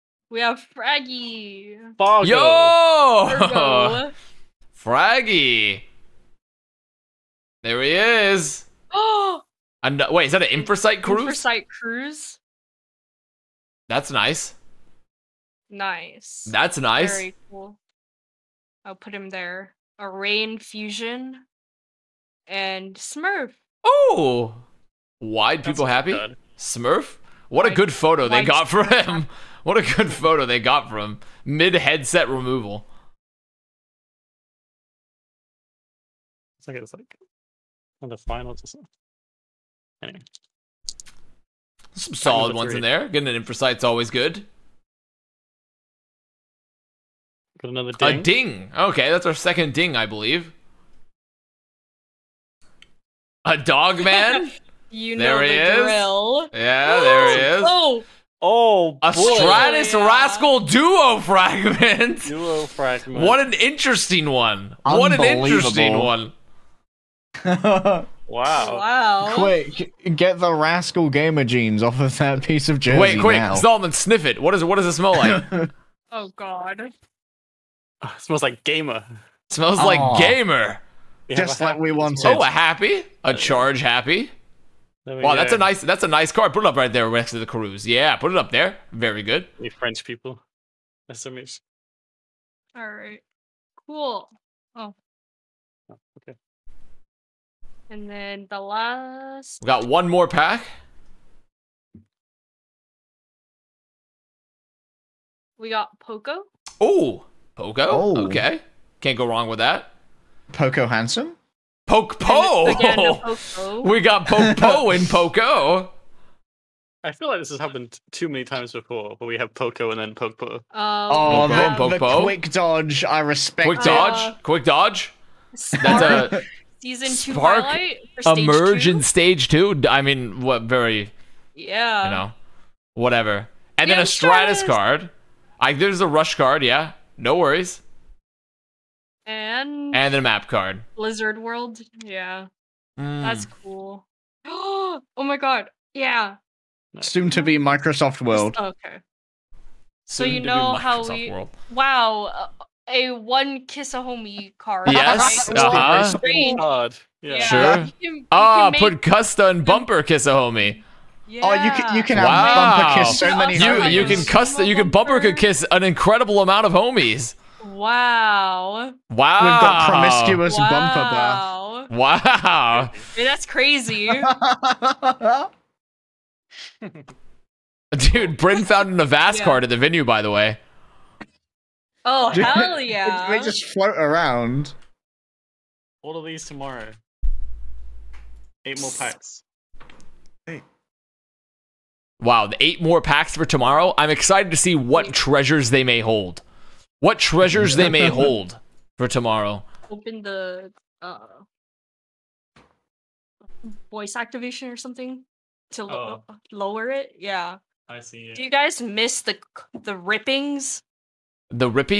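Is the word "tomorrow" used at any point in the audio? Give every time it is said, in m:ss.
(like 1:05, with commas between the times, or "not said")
3:06, 3:13, 3:19.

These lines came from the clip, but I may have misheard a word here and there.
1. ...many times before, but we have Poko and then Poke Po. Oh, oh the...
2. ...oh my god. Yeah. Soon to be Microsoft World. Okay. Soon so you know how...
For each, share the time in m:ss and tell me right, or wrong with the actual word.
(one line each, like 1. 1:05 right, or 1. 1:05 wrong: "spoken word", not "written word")
1. 1:58 right
2. 2:24 right.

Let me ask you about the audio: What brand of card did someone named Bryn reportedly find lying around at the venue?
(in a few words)
Avast.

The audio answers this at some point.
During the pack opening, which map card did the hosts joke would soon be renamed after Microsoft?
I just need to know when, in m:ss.
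2:20.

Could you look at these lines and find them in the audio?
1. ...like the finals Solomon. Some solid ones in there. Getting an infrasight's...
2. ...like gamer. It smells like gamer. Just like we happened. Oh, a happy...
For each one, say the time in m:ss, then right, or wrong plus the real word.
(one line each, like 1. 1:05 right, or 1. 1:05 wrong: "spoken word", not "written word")
1. 0:36 wrong: "Anyway", not "Solomon"
2. 1:18 wrong: "wanted", not "happened".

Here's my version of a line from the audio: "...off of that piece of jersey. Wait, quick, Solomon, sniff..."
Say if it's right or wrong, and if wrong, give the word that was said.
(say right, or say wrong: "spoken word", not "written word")
right.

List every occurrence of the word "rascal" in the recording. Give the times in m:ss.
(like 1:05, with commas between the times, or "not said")
1:00, 1:10.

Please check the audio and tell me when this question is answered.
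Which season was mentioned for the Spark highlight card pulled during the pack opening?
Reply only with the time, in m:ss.
2:06.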